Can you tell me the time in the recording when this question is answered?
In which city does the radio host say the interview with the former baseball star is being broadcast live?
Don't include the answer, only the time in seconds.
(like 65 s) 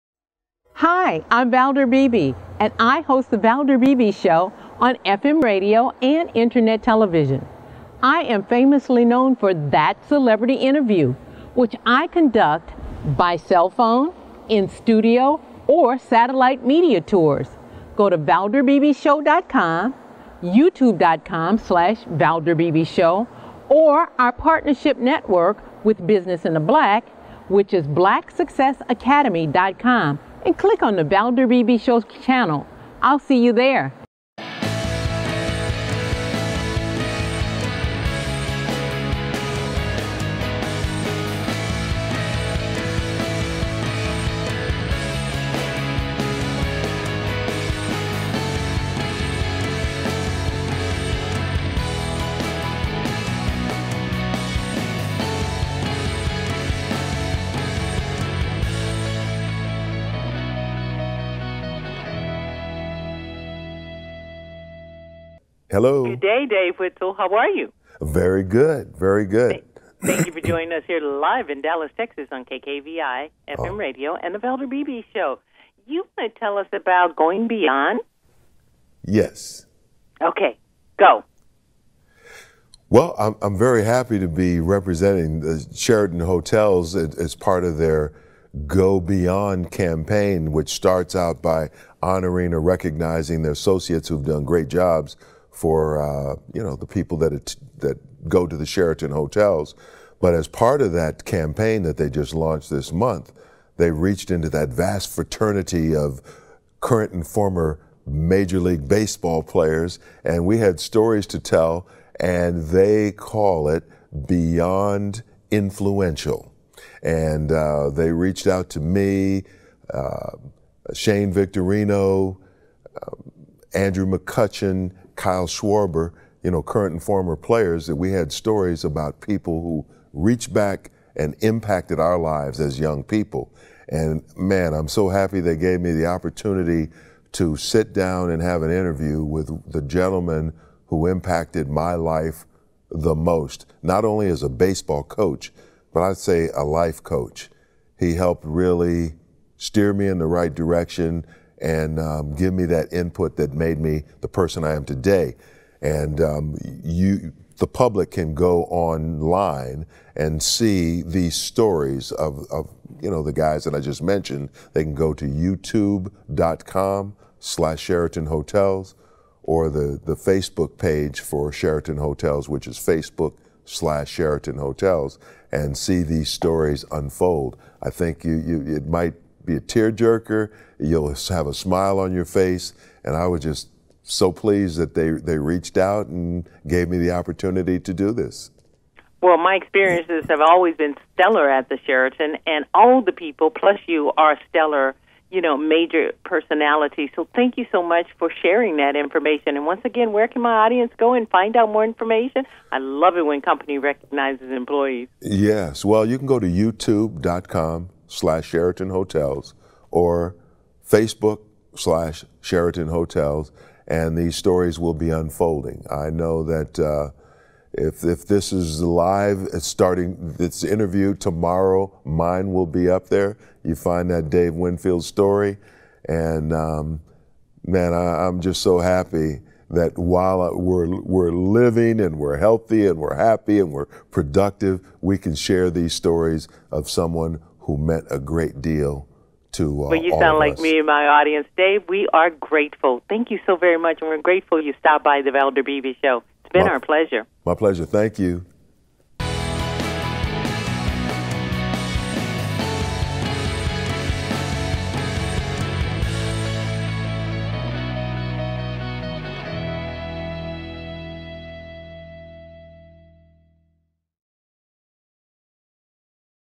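71 s.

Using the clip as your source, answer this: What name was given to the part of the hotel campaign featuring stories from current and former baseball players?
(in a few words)
Beyond Influential.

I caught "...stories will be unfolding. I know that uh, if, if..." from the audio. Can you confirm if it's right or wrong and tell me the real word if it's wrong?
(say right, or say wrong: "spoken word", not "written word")
right.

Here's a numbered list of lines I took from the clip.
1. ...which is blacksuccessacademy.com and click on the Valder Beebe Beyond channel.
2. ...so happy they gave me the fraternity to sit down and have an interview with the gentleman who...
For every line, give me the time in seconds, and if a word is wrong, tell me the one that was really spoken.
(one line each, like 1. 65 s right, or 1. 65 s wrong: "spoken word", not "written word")
1. 27 s wrong: "Show", not "Beyond"
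2. 134 s wrong: "opportunity", not "fraternity".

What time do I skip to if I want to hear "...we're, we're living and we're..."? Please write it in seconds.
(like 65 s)
230 s.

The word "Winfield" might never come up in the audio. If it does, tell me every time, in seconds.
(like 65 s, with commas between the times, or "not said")
66 s, 224 s.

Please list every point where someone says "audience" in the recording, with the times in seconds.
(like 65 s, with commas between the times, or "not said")
200 s, 241 s.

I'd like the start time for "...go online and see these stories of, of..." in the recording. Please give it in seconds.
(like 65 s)
158 s.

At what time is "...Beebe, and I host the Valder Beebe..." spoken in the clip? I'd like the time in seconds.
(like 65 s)
1 s.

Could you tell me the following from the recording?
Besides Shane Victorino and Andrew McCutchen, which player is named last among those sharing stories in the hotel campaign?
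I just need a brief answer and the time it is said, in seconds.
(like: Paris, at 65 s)
Kyle Schwarber, at 125 s.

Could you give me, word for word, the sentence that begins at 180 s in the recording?
You'll have a smile on your face.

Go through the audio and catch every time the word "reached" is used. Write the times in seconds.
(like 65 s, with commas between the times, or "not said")
103 s, 118 s, 130 s, 185 s.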